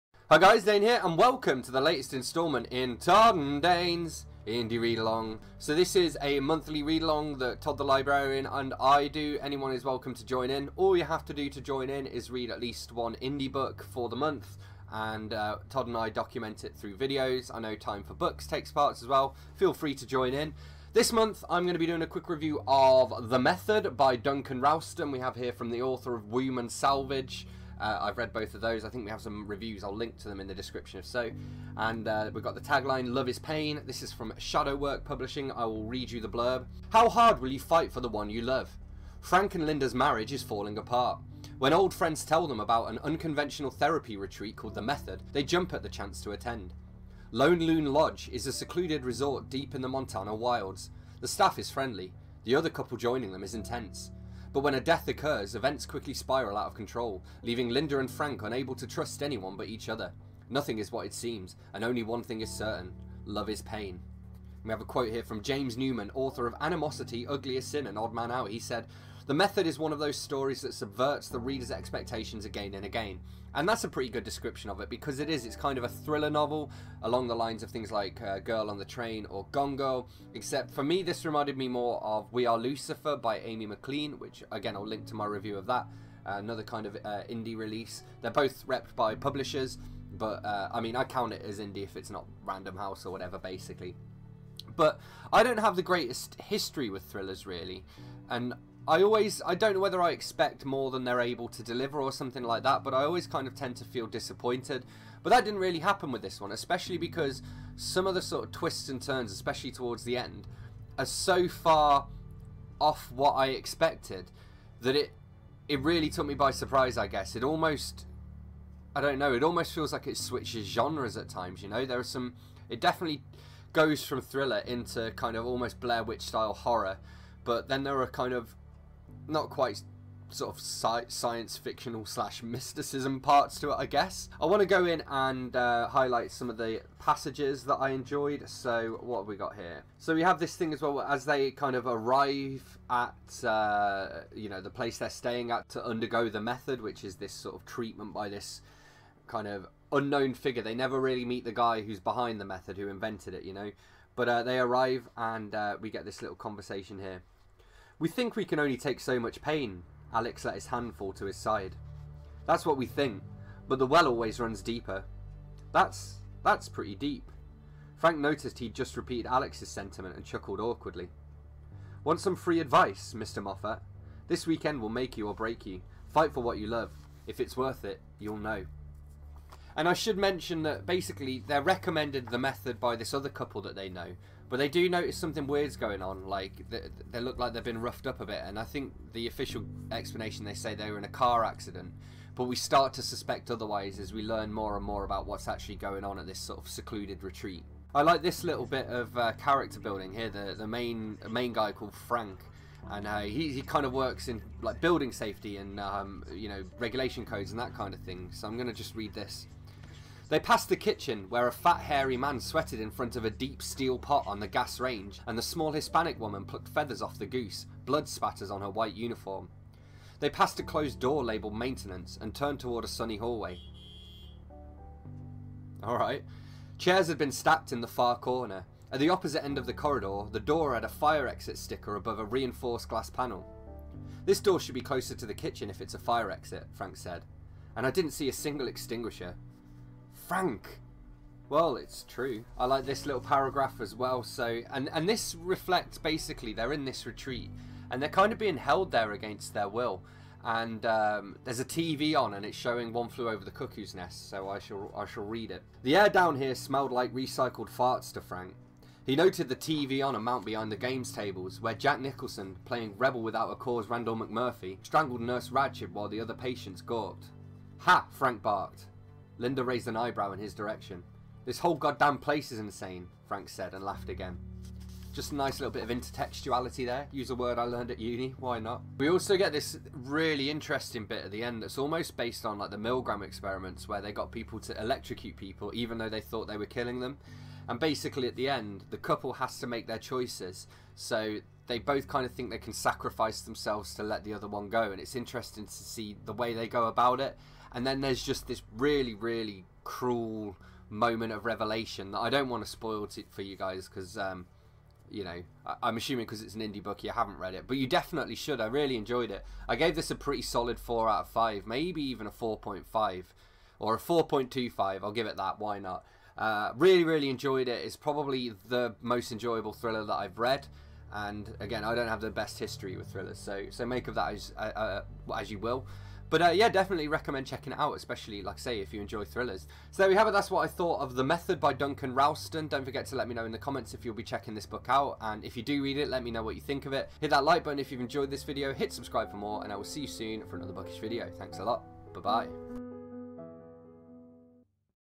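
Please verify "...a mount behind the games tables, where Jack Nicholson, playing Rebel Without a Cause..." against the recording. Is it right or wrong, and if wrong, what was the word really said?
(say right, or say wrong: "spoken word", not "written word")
right.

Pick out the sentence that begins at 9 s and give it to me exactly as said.
Anyone is welcome to join in.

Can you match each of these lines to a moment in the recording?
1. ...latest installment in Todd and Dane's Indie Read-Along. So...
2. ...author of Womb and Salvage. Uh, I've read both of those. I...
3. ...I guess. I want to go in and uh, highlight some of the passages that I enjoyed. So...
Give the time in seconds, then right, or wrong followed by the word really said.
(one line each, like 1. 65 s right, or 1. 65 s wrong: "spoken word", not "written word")
1. 1 s right
2. 25 s right
3. 133 s right.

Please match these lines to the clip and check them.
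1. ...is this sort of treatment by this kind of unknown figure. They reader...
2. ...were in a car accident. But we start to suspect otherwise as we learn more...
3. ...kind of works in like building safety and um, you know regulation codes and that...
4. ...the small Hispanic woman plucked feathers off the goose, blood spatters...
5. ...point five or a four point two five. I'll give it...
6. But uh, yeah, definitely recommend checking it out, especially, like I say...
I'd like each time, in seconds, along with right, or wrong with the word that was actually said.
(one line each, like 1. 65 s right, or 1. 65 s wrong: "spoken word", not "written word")
1. 147 s wrong: "never", not "reader"
2. 190 s right
3. 203 s right
4. 215 s right
5. 312 s right
6. 326 s right.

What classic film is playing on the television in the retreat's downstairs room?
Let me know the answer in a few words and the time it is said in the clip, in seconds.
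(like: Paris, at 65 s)
One Flew Over the Cuckoo's Nest, at 252 s.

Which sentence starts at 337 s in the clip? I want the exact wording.
Hit that like button if you've enjoyed this video.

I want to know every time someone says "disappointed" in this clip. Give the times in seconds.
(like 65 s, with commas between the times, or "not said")
104 s.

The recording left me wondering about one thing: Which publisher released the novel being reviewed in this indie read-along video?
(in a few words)
Shadowwork Publishing.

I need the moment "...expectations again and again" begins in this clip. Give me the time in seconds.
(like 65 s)
71 s.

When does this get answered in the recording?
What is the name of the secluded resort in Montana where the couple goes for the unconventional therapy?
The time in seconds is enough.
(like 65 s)
47 s.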